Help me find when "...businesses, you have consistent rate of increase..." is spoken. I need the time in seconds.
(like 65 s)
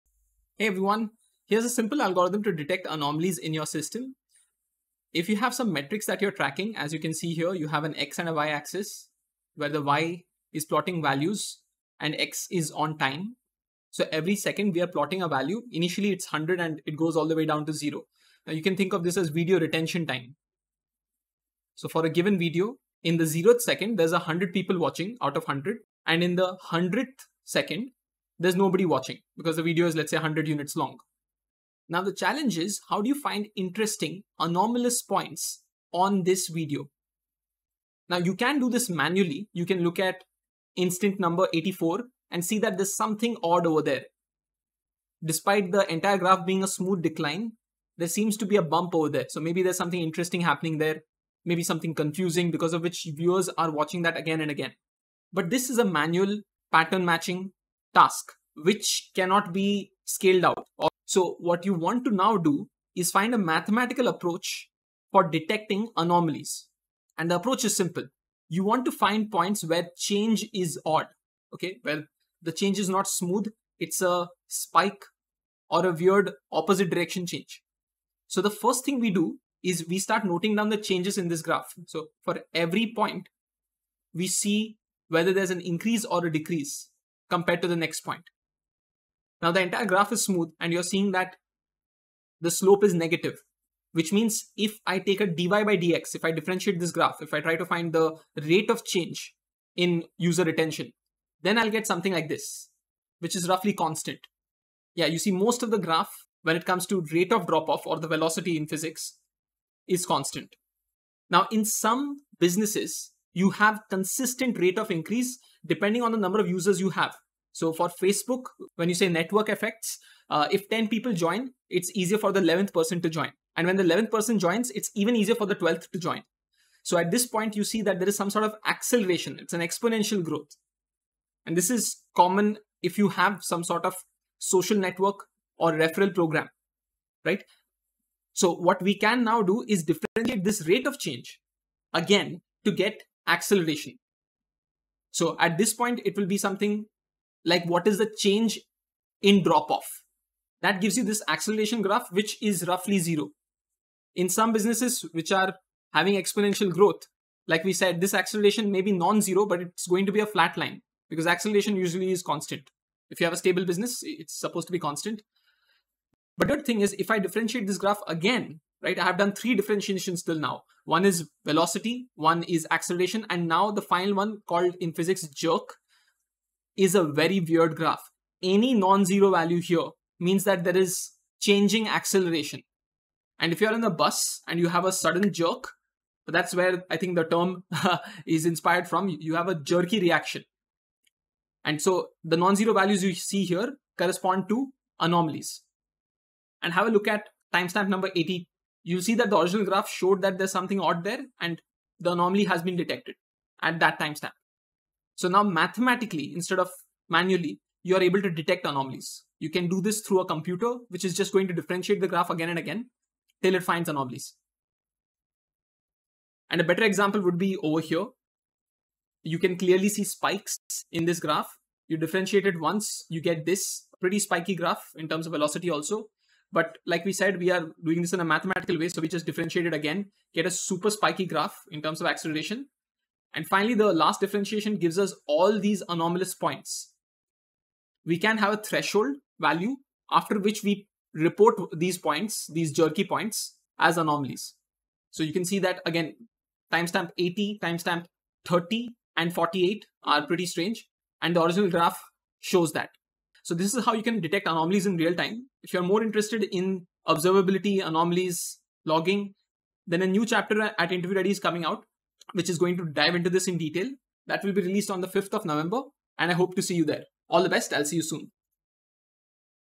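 112 s.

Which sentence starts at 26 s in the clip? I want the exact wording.
And in the 100th second, there's nobody watching because the video is, let's say, 100 units long.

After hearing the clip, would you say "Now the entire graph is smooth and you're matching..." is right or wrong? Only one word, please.
wrong.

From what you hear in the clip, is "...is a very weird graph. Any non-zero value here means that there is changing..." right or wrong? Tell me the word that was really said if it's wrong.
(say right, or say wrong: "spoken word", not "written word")
right.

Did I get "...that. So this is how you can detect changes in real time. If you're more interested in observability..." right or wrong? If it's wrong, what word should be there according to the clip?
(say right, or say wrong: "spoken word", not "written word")
wrong: "anomalies", not "changes".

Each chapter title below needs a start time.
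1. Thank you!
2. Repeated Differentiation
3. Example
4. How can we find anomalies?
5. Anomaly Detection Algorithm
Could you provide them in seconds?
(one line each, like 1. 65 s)
1. 254 s
2. 145 s
3. 216 s
4. 30 s
5. 60 s.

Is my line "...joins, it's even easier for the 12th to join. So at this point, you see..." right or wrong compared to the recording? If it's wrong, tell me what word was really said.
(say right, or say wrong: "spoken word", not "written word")
right.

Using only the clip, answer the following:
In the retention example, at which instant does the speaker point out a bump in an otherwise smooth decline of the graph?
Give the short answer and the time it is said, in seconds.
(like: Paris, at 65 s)
84, at 40 s.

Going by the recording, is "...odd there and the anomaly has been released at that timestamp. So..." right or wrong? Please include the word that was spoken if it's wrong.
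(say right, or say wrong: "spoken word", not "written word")
wrong: "detected", not "released".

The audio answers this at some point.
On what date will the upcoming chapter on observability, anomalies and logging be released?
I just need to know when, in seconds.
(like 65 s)
265 s.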